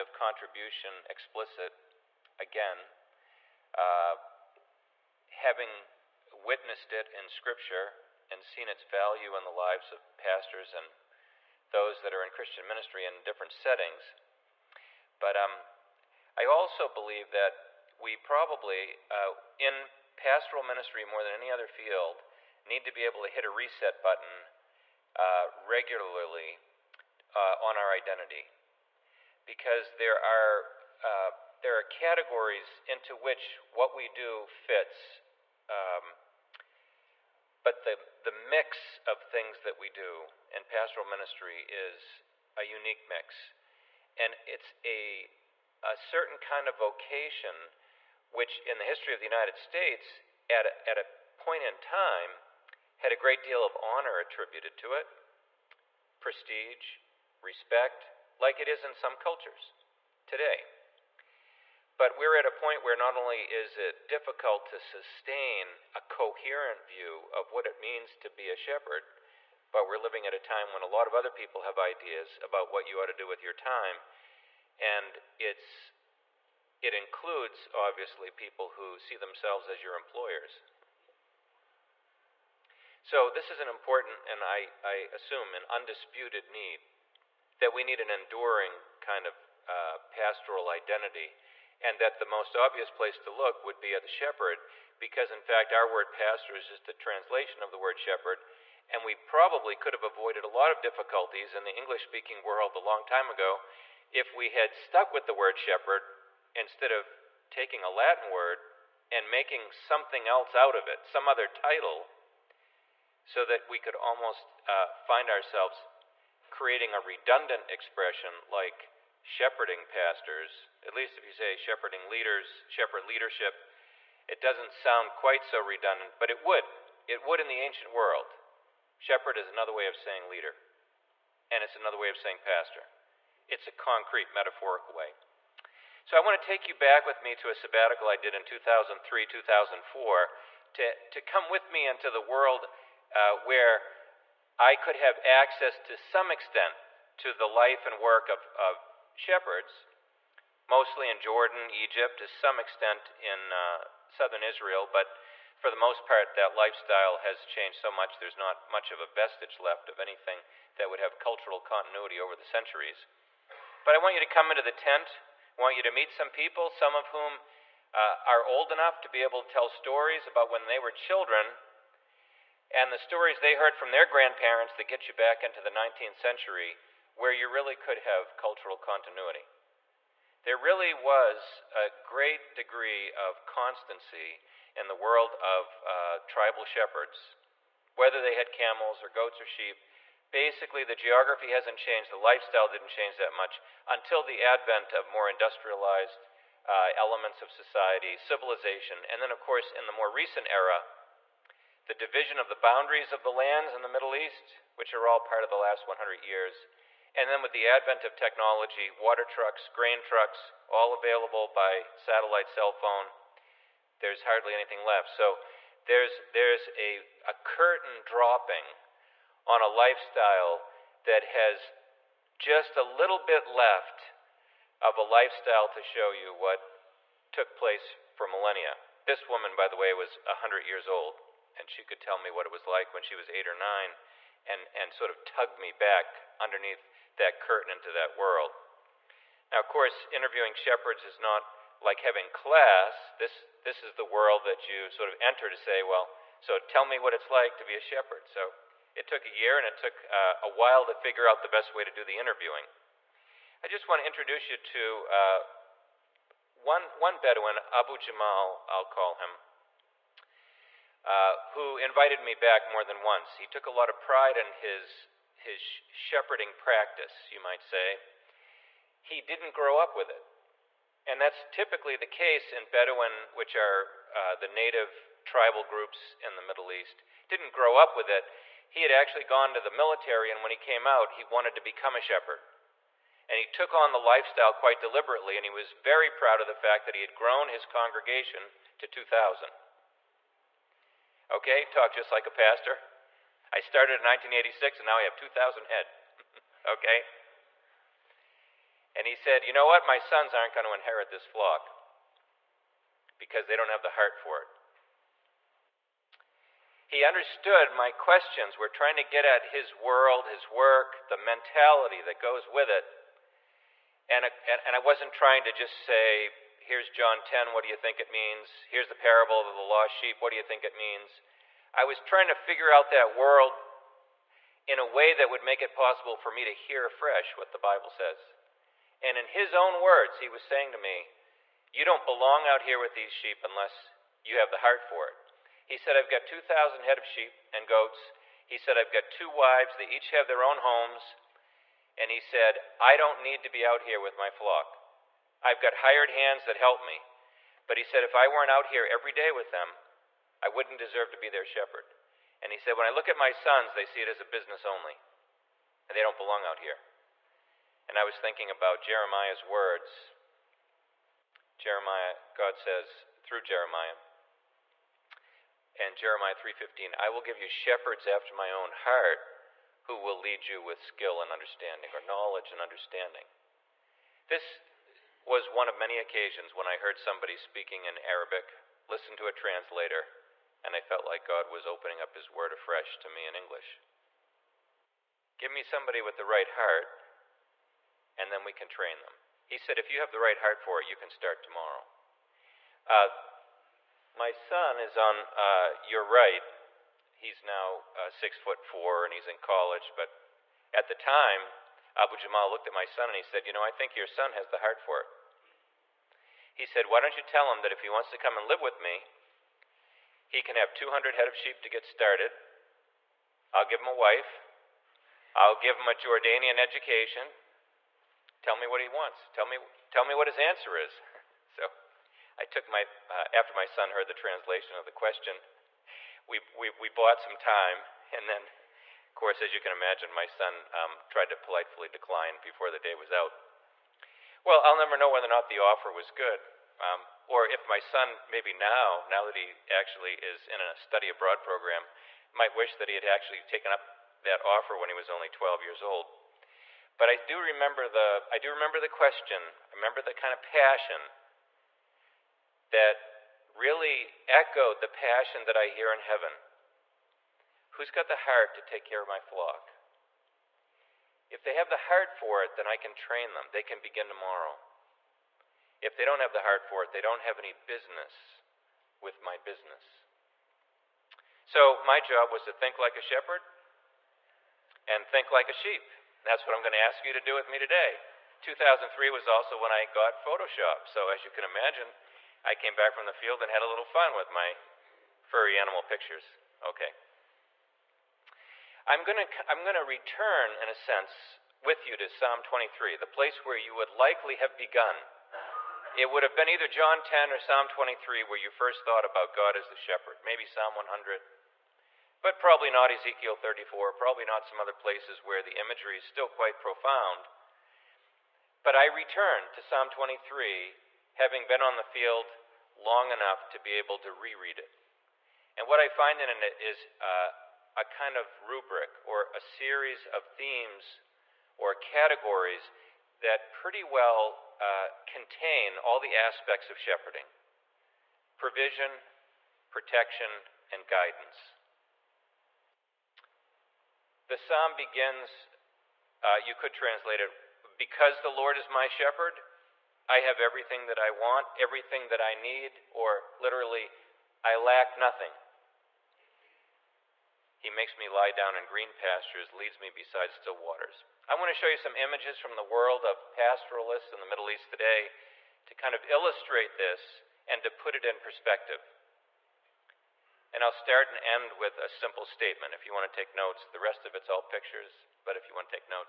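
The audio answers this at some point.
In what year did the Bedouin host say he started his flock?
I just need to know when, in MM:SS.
04:54.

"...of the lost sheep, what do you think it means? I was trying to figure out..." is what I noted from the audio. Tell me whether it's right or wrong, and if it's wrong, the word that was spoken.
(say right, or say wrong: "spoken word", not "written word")
right.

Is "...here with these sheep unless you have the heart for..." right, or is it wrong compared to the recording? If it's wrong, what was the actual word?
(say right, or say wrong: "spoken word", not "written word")
right.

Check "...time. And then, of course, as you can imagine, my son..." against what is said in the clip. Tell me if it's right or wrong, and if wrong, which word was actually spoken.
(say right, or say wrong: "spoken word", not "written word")
right.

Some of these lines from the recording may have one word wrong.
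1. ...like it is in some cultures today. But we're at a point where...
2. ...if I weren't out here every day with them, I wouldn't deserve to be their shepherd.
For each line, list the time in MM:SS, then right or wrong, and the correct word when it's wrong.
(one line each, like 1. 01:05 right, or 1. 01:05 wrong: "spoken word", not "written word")
1. 00:58 right
2. 05:48 right.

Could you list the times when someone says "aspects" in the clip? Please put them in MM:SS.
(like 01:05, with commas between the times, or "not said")
08:46.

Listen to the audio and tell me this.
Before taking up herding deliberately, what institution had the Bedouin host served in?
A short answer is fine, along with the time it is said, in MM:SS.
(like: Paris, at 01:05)
the military, at 04:39.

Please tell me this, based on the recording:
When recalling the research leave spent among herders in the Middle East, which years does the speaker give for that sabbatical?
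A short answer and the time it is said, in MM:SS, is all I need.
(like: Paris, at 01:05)
2003, 2004, at 02:18.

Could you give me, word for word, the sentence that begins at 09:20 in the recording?
And I'll start and end with a simple statement.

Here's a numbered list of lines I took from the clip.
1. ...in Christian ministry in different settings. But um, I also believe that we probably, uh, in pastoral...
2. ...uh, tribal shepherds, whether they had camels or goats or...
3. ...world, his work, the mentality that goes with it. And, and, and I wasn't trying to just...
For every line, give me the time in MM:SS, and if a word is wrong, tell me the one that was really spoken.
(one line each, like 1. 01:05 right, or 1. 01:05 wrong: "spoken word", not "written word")
1. 00:12 right
2. 03:05 right
3. 05:09 right.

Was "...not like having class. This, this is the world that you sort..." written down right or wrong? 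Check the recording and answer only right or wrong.
right.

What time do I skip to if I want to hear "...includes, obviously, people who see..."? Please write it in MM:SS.
01:16.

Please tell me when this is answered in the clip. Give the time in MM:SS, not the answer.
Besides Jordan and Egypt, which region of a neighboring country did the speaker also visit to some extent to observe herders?
02:34.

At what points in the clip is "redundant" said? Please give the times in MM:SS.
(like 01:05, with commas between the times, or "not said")
01:56, 02:05.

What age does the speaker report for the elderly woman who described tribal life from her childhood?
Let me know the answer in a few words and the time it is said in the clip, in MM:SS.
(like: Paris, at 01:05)
100, at 03:50.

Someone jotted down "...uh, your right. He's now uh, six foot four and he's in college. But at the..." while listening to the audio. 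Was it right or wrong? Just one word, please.
right.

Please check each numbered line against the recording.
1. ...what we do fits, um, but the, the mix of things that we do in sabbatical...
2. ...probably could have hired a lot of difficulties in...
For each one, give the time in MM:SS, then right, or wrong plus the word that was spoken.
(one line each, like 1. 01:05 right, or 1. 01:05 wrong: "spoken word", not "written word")
1. 00:33 wrong: "pastoral", not "sabbatical"
2. 01:39 wrong: "avoided", not "hired".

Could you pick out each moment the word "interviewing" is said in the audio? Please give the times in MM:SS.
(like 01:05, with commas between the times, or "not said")
04:00, 04:12.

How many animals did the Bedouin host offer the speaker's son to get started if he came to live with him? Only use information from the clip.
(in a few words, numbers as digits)
200.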